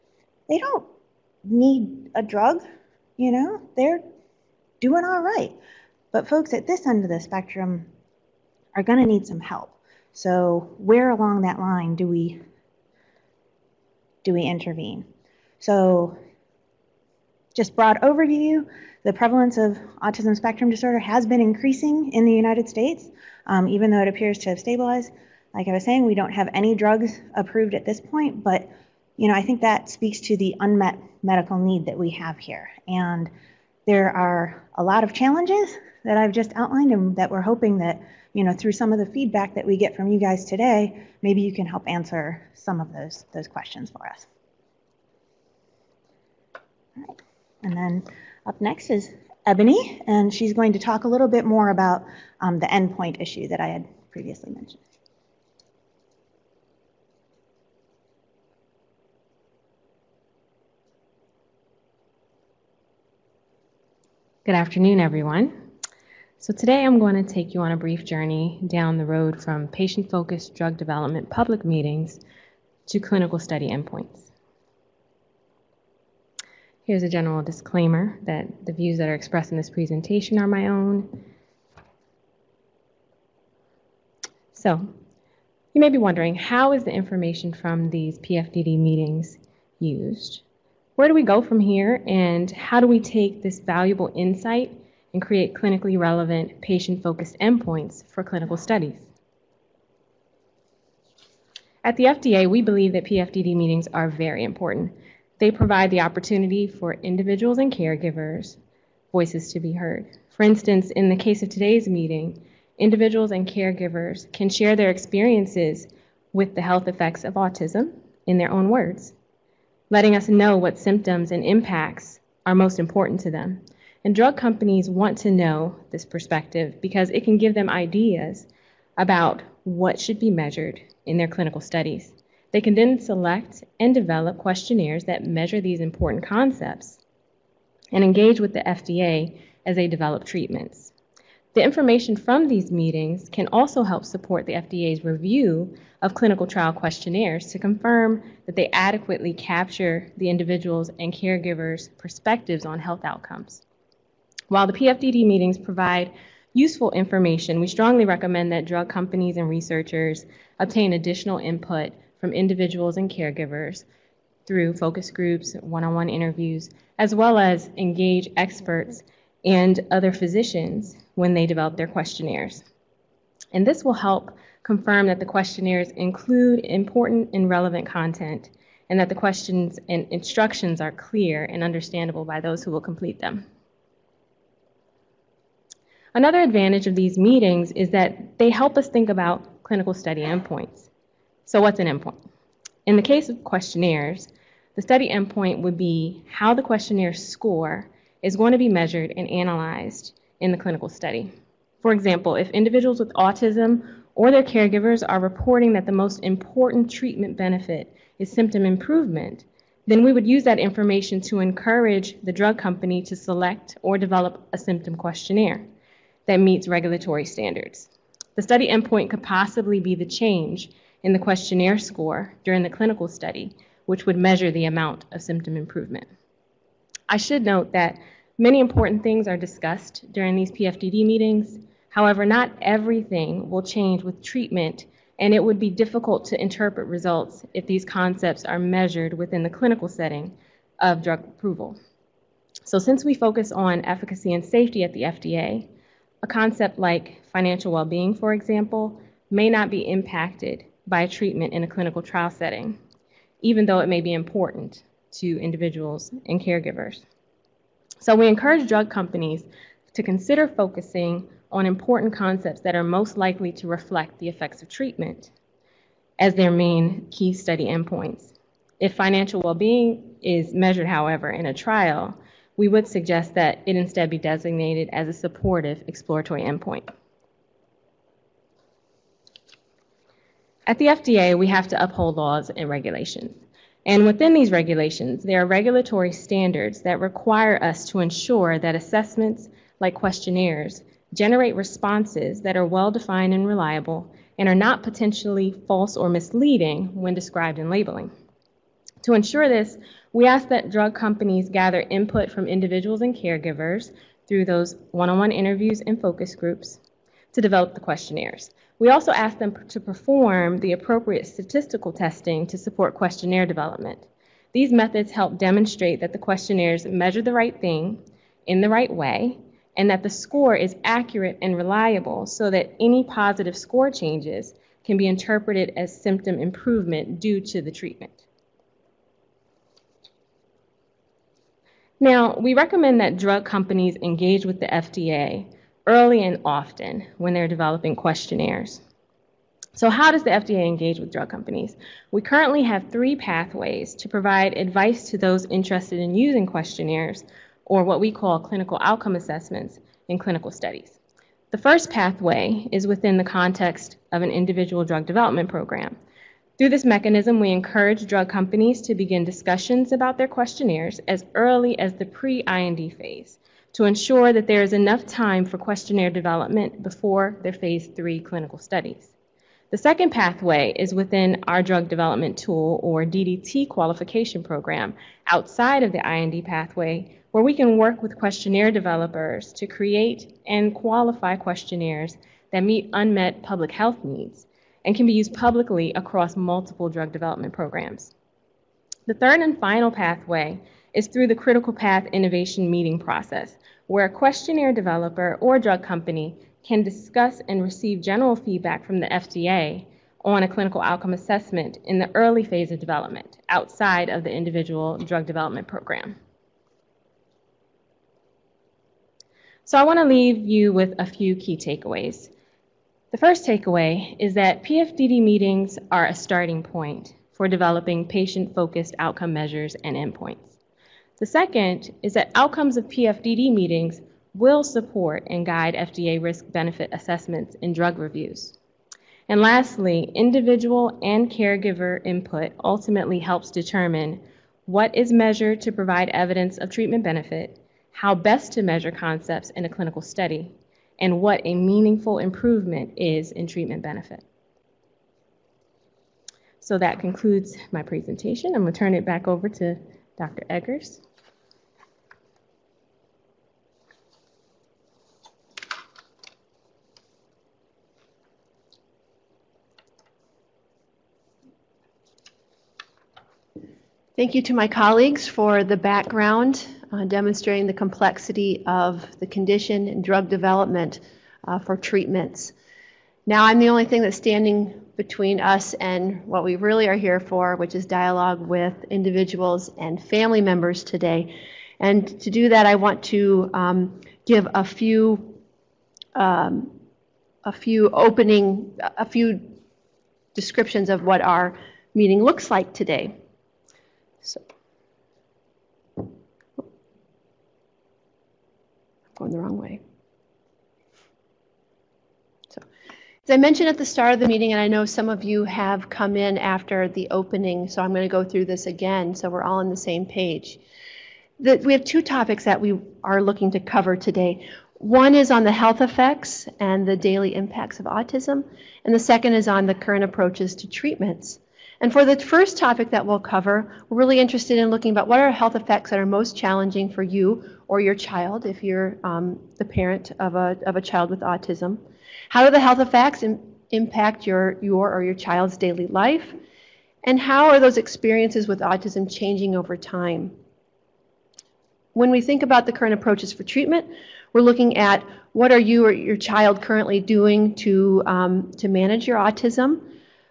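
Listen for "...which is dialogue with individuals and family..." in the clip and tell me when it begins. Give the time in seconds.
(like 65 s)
477 s.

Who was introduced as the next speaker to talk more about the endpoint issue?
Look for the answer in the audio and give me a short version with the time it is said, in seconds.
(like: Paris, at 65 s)
Ebony, at 49 s.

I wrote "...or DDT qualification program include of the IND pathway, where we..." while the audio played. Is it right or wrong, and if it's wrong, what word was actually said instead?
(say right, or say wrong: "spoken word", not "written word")
wrong: "outside", not "include".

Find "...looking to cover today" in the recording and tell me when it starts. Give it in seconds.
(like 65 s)
513 s.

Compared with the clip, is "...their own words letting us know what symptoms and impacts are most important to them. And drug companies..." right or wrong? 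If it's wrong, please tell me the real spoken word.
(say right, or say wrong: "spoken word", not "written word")
right.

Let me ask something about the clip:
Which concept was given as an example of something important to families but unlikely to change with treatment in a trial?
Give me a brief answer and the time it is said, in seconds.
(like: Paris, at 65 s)
financial well being, at 247 s.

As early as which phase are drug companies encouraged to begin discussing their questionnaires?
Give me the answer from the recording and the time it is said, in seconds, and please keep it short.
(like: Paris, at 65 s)
pre IND phase, at 362 s.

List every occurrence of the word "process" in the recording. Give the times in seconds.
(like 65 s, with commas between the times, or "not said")
392 s.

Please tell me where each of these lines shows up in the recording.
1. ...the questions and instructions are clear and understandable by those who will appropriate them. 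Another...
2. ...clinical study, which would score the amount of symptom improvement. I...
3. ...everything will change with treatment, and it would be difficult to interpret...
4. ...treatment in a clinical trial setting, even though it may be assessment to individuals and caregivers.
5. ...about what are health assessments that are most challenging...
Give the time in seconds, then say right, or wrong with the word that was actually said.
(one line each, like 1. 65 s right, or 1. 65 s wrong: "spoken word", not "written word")
1. 179 s wrong: "complete", not "appropriate"
2. 222 s wrong: "measure", not "score"
3. 232 s right
4. 251 s wrong: "important", not "assessment"
5. 524 s wrong: "effects", not "assessments".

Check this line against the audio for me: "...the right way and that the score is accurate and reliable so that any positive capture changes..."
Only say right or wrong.
wrong.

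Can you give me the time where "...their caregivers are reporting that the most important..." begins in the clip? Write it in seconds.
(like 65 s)
204 s.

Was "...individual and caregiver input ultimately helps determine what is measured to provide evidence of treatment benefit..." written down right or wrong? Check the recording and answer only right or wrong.
right.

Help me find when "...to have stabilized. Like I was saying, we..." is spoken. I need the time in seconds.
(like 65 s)
24 s.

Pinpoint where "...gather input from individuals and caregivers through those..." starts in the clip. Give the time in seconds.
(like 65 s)
301 s.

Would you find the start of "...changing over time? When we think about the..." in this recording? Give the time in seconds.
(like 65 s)
539 s.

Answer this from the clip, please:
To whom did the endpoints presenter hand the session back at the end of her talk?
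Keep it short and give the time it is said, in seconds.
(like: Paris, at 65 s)
Dr. Eggers, at 450 s.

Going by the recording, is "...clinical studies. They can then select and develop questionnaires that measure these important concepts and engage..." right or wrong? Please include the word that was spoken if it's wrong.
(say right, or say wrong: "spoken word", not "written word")
right.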